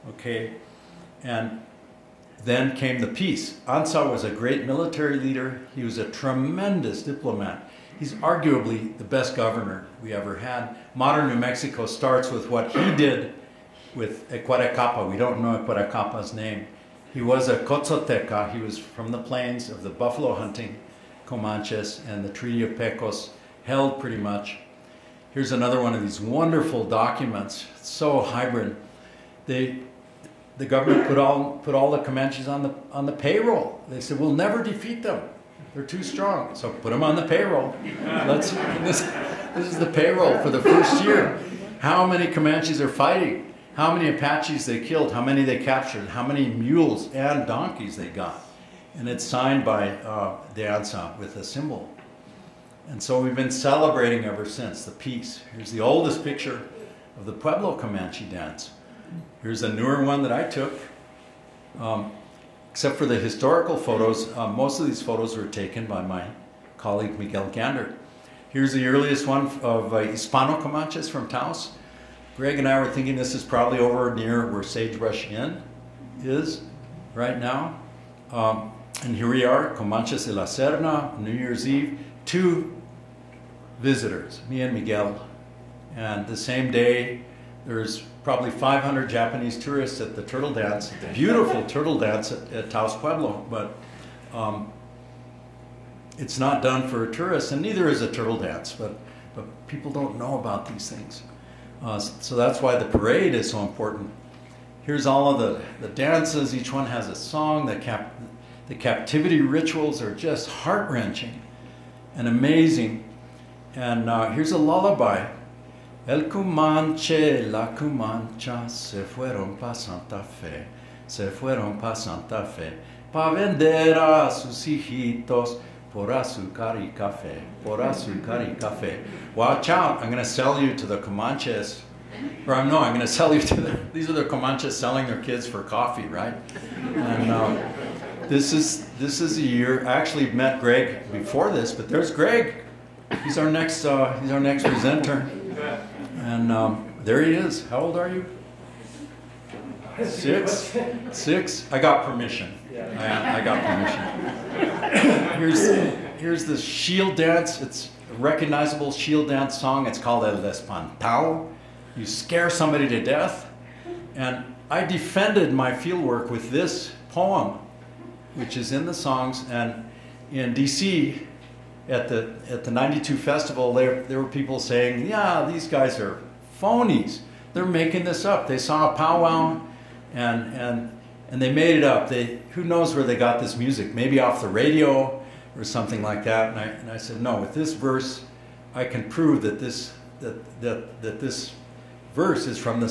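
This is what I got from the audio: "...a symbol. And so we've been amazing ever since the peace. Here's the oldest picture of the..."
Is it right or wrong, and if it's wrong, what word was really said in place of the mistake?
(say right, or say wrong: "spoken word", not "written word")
wrong: "celebrating", not "amazing".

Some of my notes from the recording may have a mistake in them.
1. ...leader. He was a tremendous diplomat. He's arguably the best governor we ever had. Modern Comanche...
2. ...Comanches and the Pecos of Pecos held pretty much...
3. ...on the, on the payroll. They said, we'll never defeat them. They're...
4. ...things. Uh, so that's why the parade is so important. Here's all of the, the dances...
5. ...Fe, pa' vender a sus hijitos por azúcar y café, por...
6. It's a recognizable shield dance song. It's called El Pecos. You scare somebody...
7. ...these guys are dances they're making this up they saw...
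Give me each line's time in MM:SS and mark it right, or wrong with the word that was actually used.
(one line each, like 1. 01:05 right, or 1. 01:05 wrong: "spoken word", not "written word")
1. 00:05 wrong: "New", not "Comanche"
2. 00:21 wrong: "Treaty", not "Pecos"
3. 00:32 right
4. 01:40 right
5. 02:02 right
6. 02:37 wrong: "Espantao", not "Pecos"
7. 02:55 wrong: "phonies", not "dances".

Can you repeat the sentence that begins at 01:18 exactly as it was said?
Um, and here we are, Comanches de la Serna, New Year's Eve, two visitors, me and Miguel.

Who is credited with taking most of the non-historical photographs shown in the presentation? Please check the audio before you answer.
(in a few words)
Miguel Gandert.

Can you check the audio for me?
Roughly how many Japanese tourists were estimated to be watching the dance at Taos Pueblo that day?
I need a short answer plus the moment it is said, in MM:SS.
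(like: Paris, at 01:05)
500, at 01:28.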